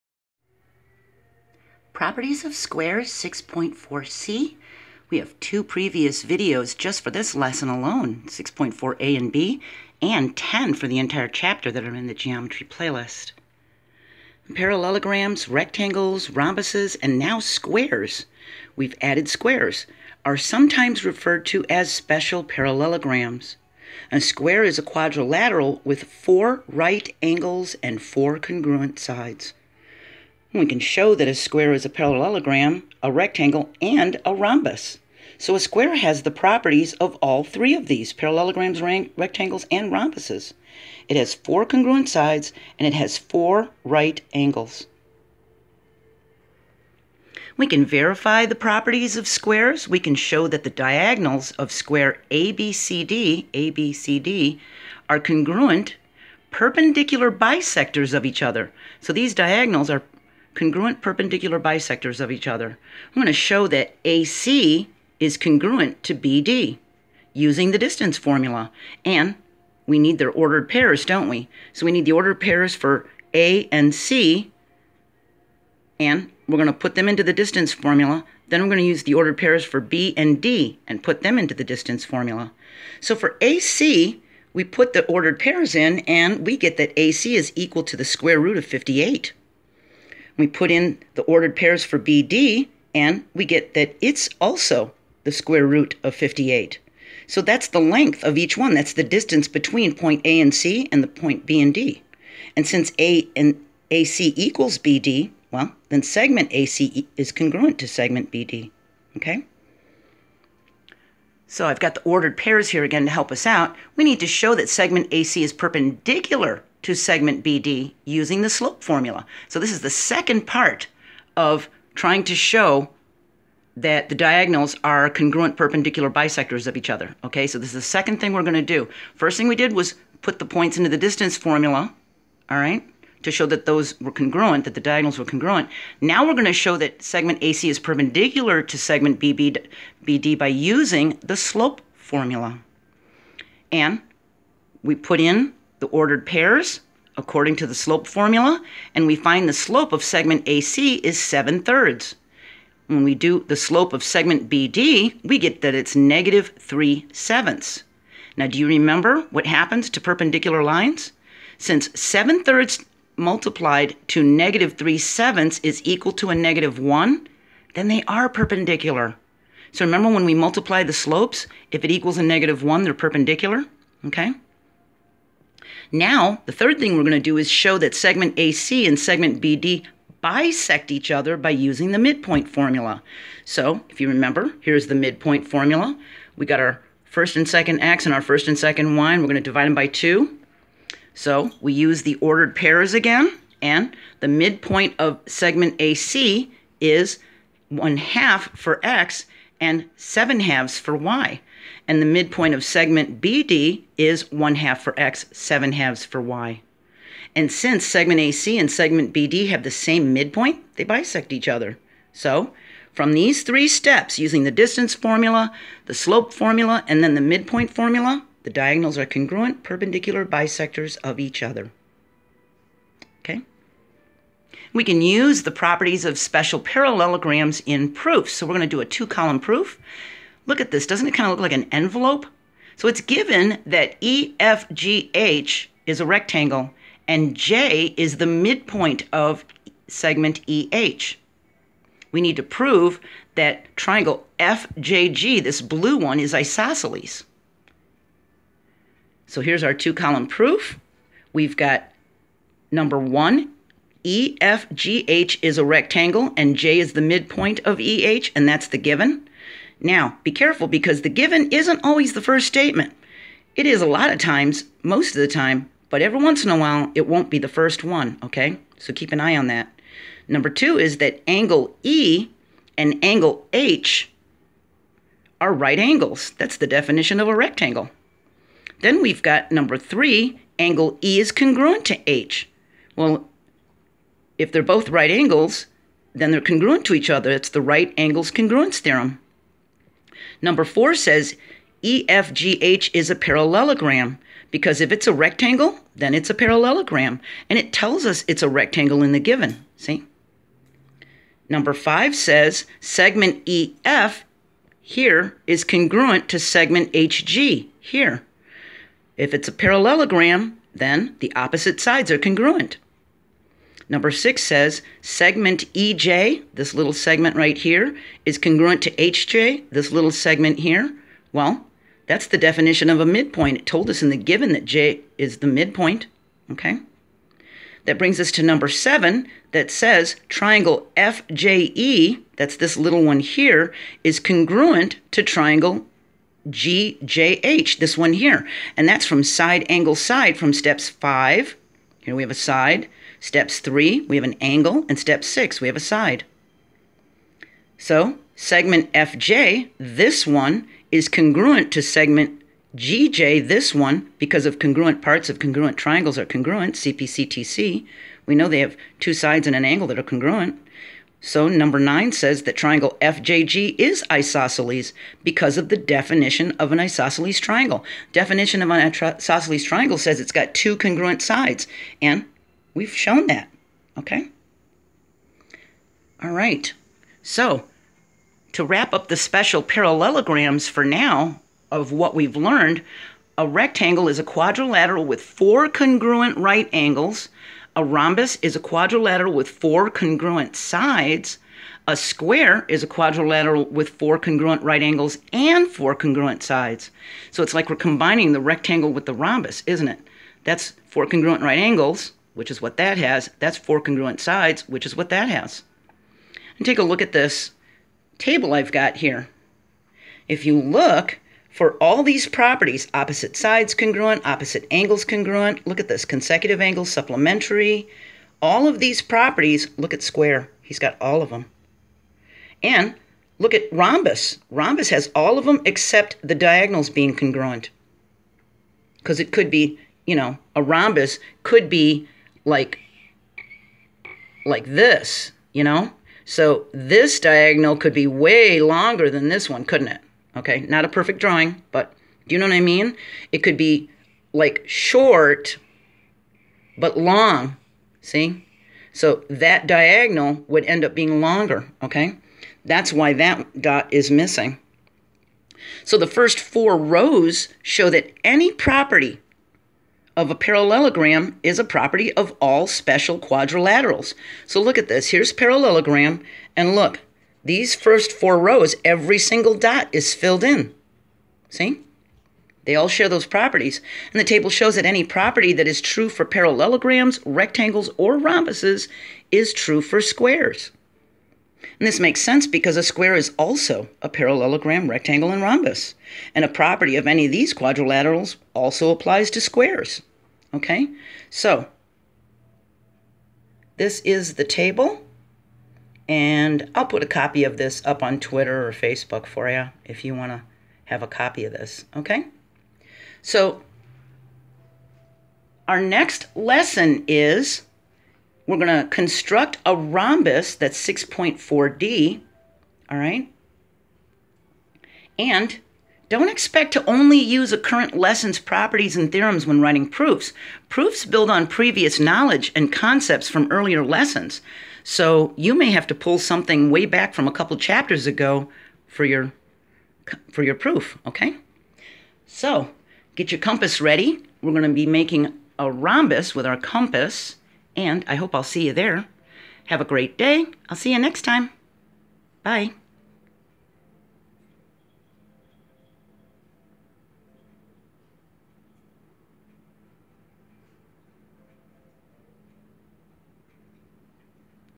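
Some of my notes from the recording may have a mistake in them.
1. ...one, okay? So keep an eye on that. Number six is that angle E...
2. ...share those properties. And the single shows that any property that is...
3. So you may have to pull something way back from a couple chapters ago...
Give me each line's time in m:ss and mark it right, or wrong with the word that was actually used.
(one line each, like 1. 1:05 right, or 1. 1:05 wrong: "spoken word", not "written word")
1. 4:27 wrong: "two", not "six"
2. 7:52 wrong: "table", not "single"
3. 8:44 right.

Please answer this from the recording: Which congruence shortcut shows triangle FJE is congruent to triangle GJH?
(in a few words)
Side angle side.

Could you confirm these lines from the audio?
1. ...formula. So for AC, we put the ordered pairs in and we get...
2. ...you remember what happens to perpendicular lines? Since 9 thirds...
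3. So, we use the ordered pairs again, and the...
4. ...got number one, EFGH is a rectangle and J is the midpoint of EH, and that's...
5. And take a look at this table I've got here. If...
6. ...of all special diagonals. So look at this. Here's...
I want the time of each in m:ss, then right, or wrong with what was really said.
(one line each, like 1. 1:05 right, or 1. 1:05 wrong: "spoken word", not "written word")
1. 1:22 right
2. 2:38 wrong: "7", not "9"
3. 3:11 right
4. 4:11 right
5. 6:46 right
6. 7:42 wrong: "quadrilaterals", not "diagonals".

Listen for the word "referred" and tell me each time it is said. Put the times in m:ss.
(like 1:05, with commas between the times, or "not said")
0:21.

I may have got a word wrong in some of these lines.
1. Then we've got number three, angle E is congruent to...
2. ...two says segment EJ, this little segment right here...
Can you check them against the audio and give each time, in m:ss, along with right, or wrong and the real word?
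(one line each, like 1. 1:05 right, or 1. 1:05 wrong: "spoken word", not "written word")
1. 4:38 right
2. 5:14 wrong: "six", not "two".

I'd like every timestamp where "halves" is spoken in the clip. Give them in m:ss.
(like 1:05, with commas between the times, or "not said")
3:20, 3:25.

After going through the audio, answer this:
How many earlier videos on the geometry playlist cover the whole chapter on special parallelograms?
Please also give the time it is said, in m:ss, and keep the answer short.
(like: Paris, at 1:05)
10, at 0:10.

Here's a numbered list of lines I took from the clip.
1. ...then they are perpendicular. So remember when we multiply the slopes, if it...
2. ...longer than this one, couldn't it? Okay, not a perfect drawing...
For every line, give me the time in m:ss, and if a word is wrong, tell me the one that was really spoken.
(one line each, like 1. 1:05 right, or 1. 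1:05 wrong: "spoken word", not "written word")
1. 2:47 right
2. 7:18 right.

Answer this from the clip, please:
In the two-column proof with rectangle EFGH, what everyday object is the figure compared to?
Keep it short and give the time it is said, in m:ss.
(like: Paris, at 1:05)
An envelope, at 3:51.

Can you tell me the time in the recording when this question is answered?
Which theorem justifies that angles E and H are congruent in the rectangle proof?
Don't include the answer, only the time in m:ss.
4:47.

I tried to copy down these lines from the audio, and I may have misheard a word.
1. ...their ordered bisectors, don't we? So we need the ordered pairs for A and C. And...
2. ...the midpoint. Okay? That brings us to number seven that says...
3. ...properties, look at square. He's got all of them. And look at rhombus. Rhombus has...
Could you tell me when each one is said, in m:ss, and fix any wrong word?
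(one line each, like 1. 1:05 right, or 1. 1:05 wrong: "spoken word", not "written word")
1. 1:10 wrong: "pairs", not "bisectors"
2. 5:25 right
3. 6:59 right.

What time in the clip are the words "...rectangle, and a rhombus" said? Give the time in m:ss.
0:33.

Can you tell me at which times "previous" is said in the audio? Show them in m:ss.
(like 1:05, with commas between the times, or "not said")
0:05, 8:41.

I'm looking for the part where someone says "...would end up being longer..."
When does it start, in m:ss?
7:30.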